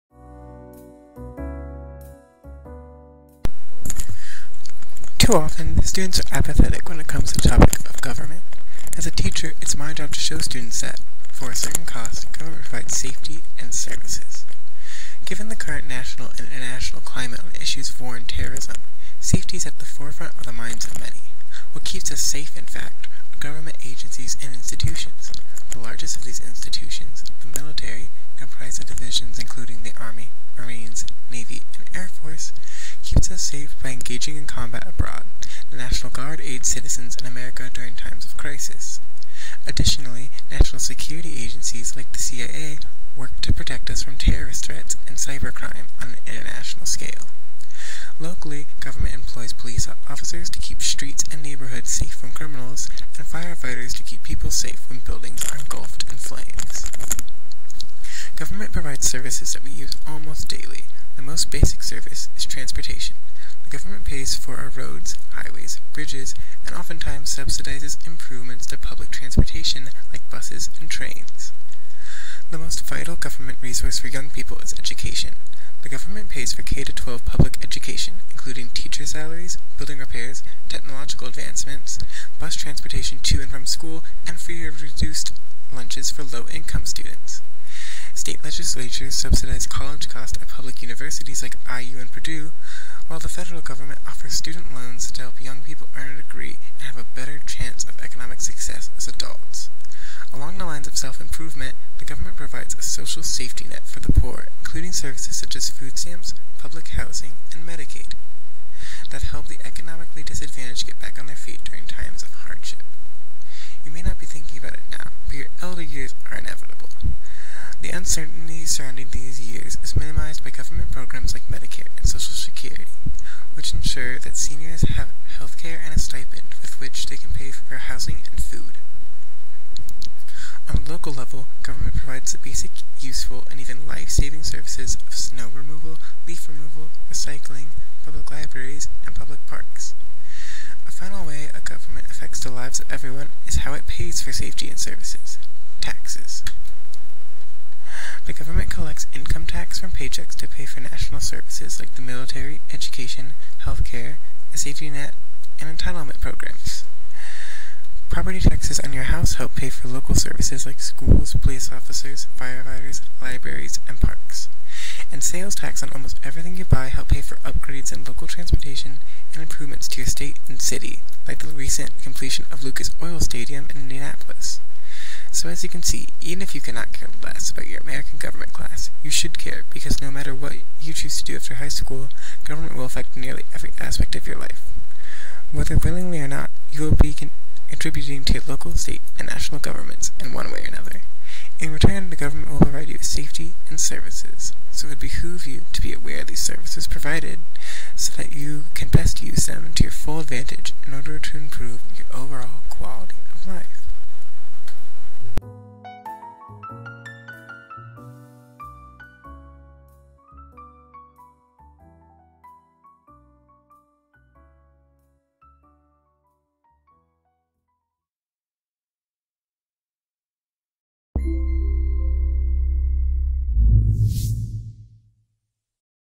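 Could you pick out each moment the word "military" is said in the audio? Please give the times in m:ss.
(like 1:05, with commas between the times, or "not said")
0:27, 2:32.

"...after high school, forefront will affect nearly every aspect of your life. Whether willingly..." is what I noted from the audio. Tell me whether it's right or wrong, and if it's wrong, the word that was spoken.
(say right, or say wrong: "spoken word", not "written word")
wrong: "government", not "forefront".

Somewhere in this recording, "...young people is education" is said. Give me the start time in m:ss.
1:14.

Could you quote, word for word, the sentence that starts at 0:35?
The National Guard aids citizens in America during times of crisis.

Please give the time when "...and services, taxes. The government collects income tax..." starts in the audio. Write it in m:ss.
2:24.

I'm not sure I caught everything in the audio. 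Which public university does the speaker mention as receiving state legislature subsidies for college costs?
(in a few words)
Purdue.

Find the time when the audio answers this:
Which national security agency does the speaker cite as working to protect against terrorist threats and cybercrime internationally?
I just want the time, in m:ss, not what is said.
0:42.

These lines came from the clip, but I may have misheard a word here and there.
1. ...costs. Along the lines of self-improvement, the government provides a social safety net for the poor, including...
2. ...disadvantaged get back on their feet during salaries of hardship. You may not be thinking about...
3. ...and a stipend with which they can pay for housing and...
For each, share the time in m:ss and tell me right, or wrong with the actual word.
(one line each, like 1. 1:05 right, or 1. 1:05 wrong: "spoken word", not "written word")
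1. 1:39 wrong: "adults", not "costs"
2. 1:50 wrong: "times", not "salaries"
3. 2:05 right.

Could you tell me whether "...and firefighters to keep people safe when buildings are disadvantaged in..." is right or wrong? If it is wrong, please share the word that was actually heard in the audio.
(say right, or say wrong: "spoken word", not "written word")
wrong: "engulfed", not "disadvantaged".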